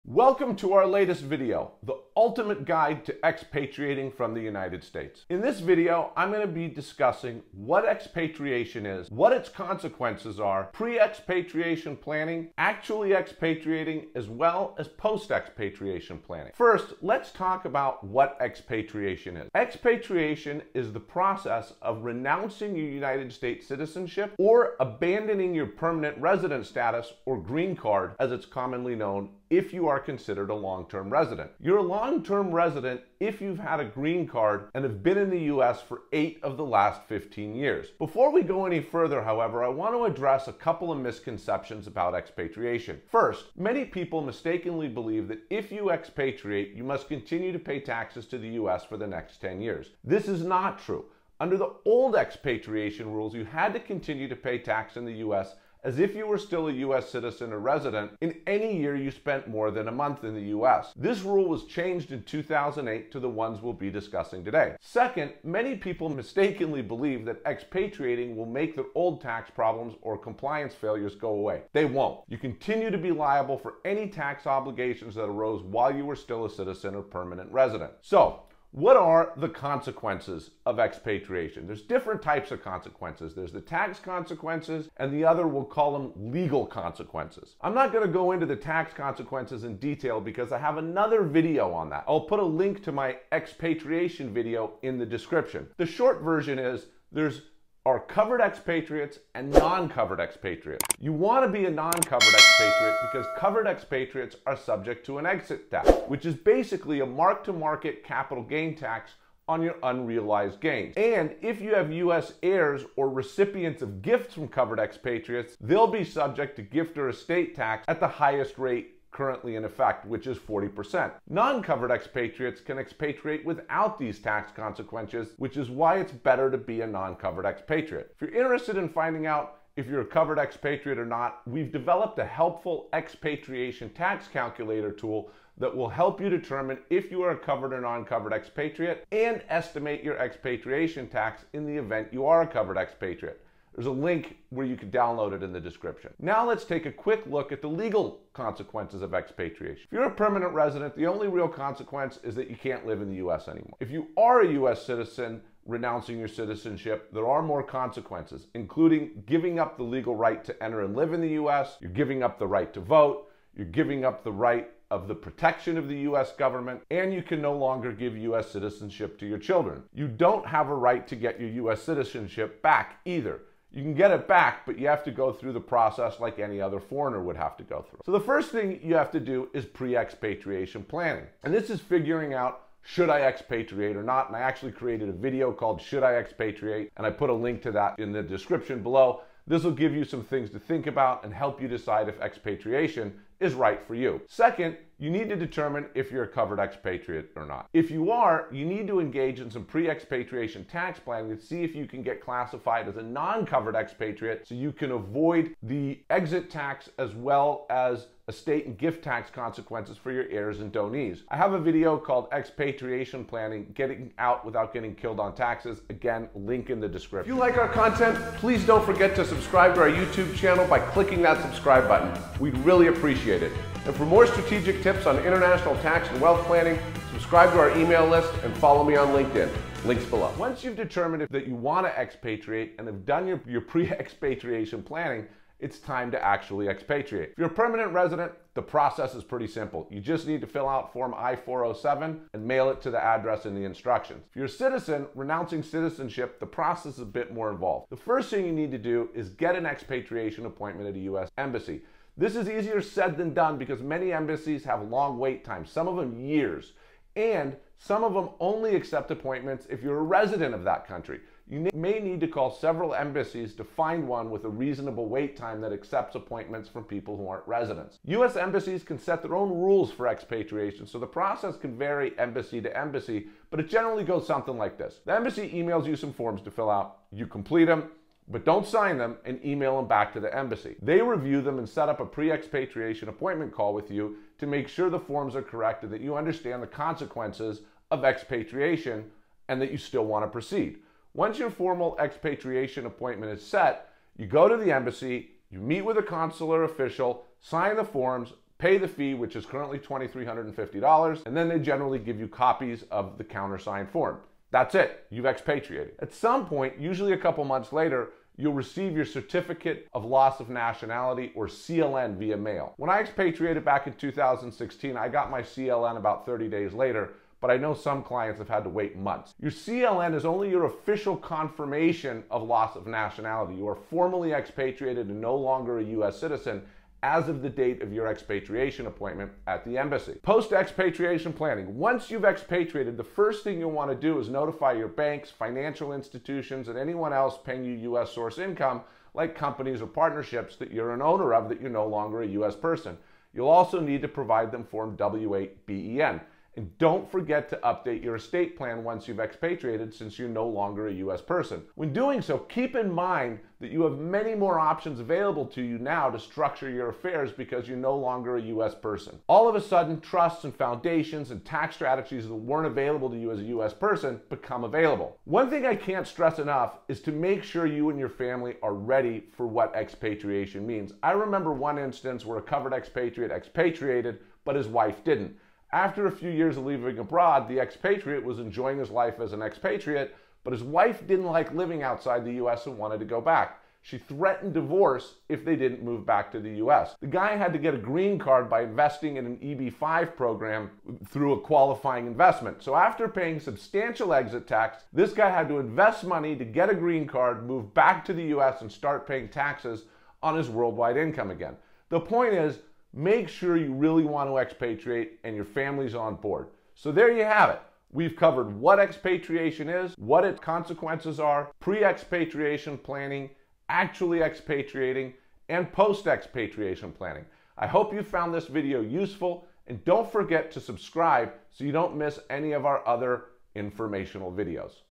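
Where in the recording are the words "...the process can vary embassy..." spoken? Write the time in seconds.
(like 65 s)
270 s.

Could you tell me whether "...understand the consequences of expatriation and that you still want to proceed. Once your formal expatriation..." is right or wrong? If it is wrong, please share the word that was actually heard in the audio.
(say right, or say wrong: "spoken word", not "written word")
right.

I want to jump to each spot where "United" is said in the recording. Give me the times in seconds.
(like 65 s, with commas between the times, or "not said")
4 s, 22 s.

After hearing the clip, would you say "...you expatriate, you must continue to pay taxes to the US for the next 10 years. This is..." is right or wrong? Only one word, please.
right.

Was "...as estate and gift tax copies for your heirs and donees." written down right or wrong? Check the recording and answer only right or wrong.
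wrong.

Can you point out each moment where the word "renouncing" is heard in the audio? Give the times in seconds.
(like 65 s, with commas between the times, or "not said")
22 s, 155 s, 245 s.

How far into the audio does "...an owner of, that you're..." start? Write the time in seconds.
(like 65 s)
340 s.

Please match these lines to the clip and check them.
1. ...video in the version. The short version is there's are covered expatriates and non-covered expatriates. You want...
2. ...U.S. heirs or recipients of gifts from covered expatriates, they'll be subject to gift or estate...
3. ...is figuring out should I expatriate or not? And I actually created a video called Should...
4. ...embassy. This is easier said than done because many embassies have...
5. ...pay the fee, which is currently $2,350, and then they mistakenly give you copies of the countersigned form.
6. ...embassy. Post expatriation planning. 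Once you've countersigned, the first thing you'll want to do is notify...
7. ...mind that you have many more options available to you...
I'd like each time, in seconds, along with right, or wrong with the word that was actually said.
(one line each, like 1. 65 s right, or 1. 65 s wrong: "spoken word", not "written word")
1. 94 s wrong: "description", not "version"
2. 111 s right
3. 181 s right
4. 251 s right
5. 298 s wrong: "generally", not "mistakenly"
6. 329 s wrong: "expatriated", not "countersigned"
7. 352 s right.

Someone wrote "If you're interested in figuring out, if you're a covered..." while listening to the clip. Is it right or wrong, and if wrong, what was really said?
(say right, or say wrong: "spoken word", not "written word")
wrong: "finding", not "figuring".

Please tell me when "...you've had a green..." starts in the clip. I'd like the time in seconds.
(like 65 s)
33 s.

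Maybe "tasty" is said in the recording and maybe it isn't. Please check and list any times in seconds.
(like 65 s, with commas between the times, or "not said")
not said.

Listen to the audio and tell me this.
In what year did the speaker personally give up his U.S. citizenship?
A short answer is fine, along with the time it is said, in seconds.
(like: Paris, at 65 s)
2016, at 313 s.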